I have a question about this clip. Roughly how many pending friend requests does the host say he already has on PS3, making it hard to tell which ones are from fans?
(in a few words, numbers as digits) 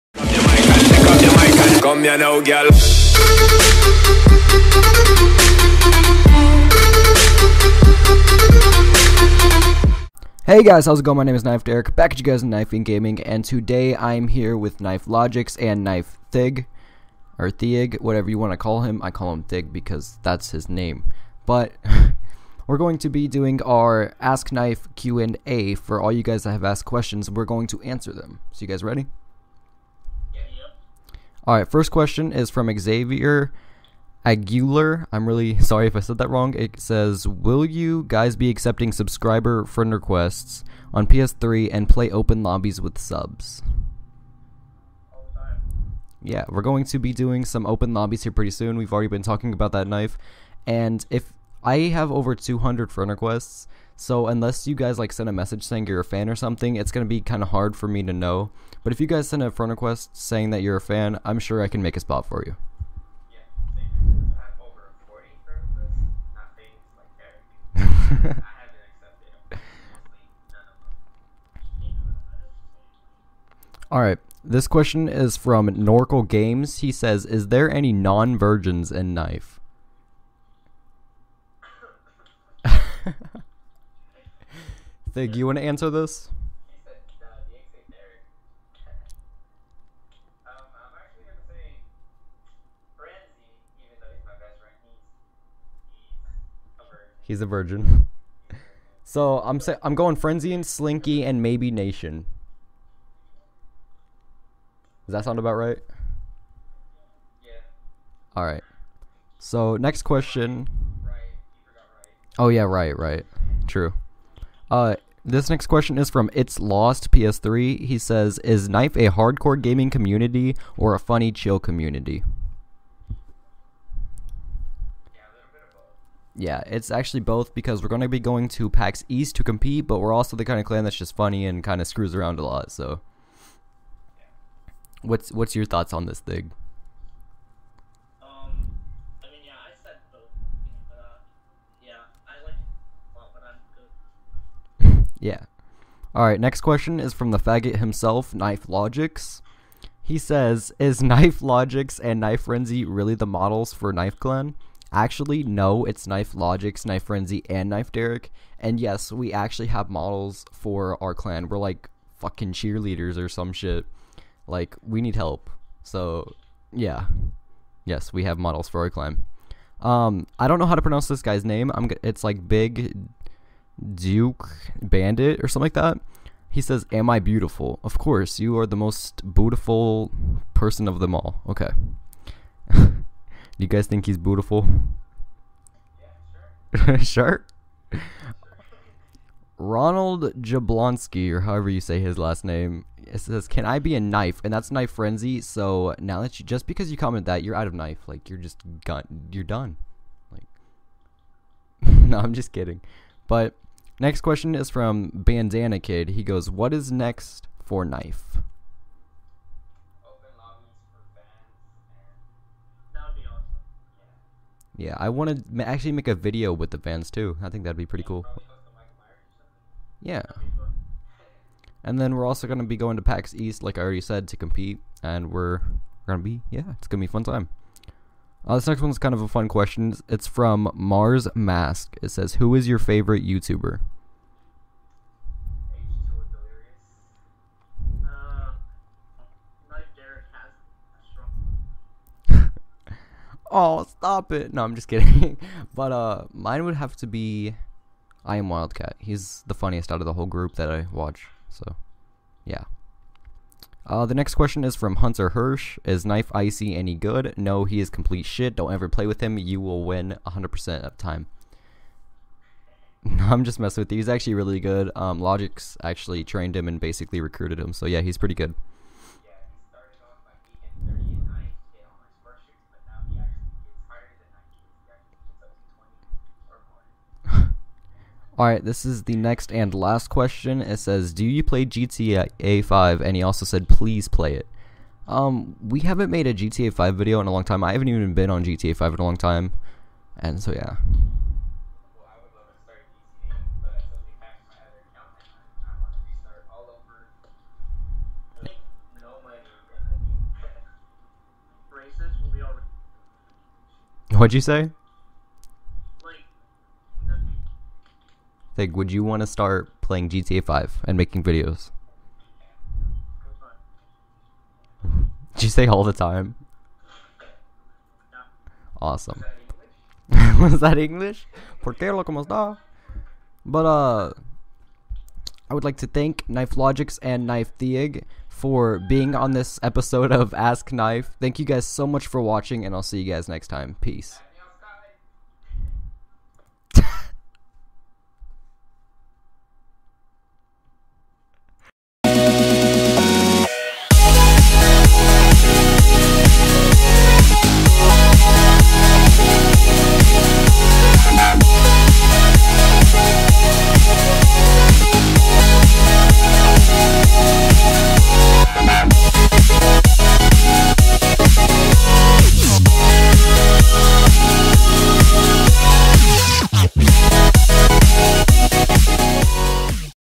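over 200.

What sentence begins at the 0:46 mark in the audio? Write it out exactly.
Yeah, we're going to be doing some open lobbies here pretty soon.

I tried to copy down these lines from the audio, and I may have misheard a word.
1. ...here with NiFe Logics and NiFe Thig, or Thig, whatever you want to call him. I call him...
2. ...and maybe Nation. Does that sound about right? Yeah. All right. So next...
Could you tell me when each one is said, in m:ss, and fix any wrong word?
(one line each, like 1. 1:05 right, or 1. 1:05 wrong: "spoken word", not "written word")
1. 0:14 right
2. 1:41 right.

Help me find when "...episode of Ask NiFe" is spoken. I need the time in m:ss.
5:29.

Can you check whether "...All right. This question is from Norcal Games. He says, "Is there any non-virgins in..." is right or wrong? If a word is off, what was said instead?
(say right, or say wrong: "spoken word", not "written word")
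right.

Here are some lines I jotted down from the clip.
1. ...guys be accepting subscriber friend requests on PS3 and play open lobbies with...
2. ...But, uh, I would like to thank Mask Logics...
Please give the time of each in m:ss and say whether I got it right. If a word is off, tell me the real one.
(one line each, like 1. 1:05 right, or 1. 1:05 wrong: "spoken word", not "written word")
1. 0:38 right
2. 5:23 wrong: "NiFe", not "Mask".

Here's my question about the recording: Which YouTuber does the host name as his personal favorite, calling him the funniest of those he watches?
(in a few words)
I am Wildcat.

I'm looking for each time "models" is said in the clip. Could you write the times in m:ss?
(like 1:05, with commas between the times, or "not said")
2:33, 2:39, 2:48.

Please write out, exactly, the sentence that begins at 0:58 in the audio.
But if you guys send a friend request saying that you're a fan, I'm sure I can make a spot for you.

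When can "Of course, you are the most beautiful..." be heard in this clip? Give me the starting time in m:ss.
2:57.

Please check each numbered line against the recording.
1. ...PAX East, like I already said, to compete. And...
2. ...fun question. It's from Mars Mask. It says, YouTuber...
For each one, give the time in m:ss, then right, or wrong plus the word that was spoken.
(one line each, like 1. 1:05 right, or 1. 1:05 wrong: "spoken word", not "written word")
1. 3:43 right
2. 3:49 wrong: "Who", not "YouTuber".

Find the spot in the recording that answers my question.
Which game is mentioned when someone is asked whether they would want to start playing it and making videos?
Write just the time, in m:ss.
5:10.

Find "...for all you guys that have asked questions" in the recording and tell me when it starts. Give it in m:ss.
0:25.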